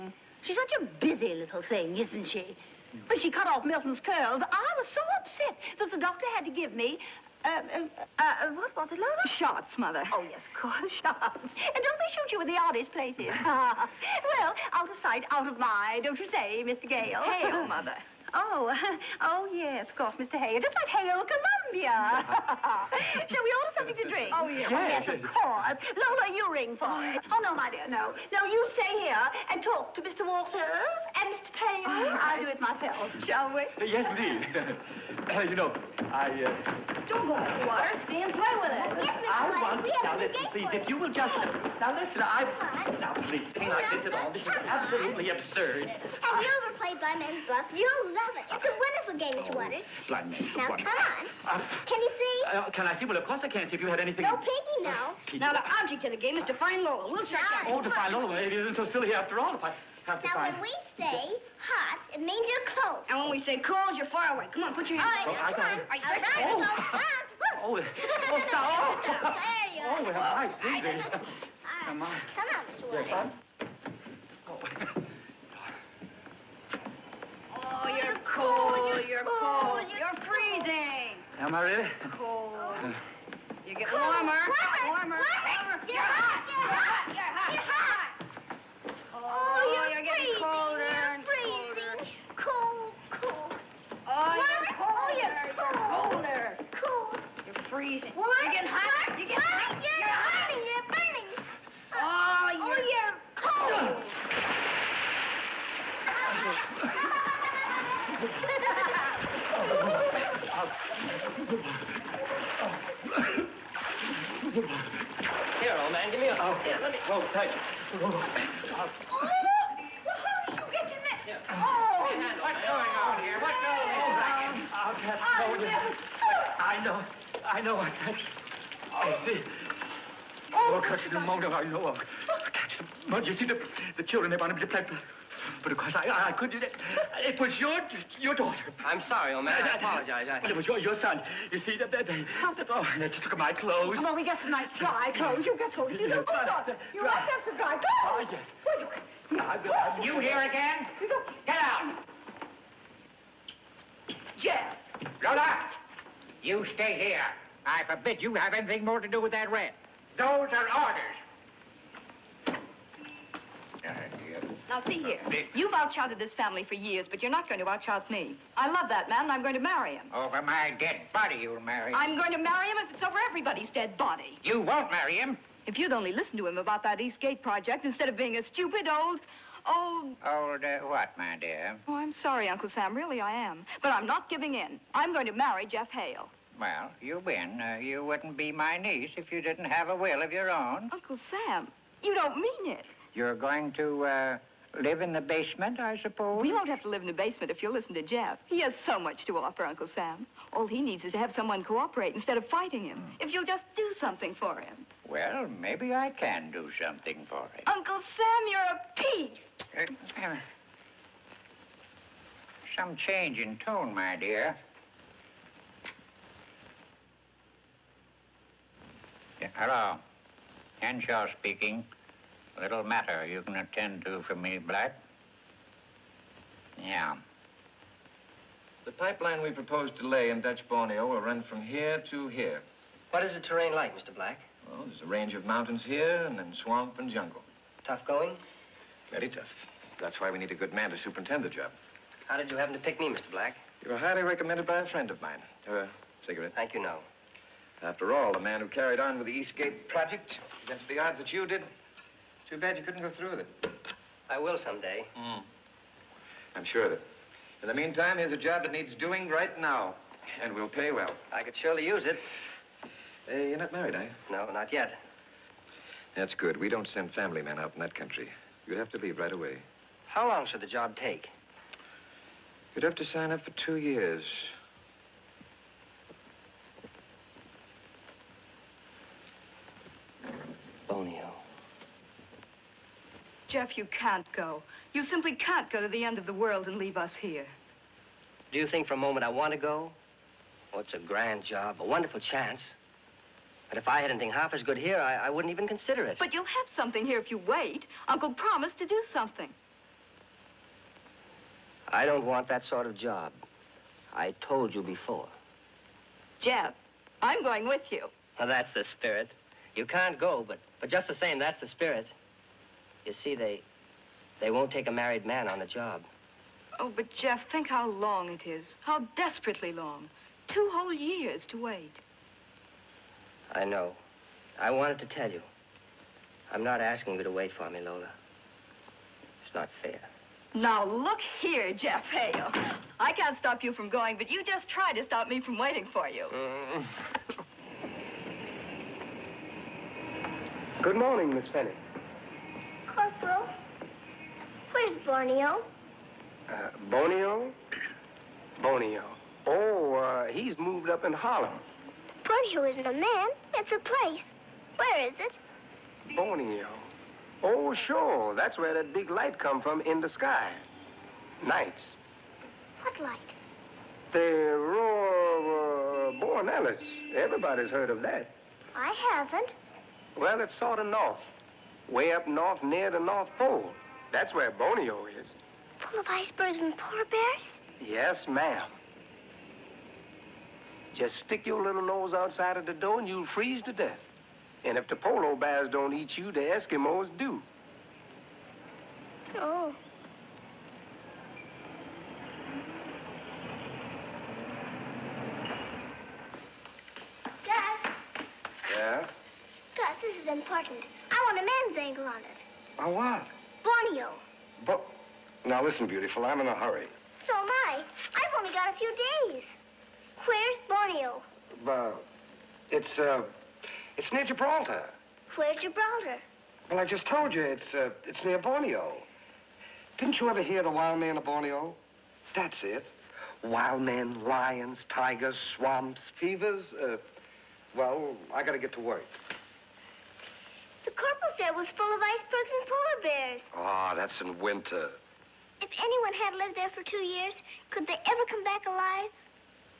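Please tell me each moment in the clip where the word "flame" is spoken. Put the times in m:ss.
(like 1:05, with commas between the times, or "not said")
not said.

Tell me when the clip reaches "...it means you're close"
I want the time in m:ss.
1:02.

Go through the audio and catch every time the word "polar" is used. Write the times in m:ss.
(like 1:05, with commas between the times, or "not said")
6:16, 6:24, 7:12.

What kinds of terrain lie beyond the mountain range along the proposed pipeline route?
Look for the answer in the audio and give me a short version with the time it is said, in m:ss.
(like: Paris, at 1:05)
Swamp and jungle, at 3:56.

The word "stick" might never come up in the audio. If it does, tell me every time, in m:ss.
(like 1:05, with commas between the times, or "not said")
6:21.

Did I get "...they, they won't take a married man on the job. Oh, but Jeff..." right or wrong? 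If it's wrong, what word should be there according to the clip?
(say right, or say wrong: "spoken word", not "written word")
right.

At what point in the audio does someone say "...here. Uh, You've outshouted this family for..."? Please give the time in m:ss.
2:45.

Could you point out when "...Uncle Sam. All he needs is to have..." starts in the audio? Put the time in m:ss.
3:19.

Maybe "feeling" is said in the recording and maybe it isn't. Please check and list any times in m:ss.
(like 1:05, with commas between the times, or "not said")
not said.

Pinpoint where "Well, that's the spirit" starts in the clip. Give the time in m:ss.
5:08.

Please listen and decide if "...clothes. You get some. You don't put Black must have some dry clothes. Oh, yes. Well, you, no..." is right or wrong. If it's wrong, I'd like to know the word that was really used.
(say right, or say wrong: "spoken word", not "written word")
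wrong: "You", not "Black".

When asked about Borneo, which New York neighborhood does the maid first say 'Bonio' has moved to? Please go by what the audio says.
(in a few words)
Harlem.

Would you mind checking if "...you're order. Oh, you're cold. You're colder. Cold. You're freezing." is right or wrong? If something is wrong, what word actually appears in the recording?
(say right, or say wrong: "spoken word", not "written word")
wrong: "colder", not "order".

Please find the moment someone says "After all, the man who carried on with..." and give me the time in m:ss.
4:07.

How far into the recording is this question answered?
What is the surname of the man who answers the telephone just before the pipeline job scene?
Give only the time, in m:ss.
3:40.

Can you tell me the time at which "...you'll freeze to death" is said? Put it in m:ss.
6:23.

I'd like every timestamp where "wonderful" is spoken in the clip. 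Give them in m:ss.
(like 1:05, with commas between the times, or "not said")
0:48, 4:51.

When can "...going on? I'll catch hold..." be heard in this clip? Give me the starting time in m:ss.
2:03.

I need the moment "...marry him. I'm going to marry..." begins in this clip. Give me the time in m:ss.
2:51.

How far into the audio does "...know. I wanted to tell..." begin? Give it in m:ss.
5:23.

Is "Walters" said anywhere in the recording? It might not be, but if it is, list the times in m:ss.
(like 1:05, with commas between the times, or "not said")
0:30.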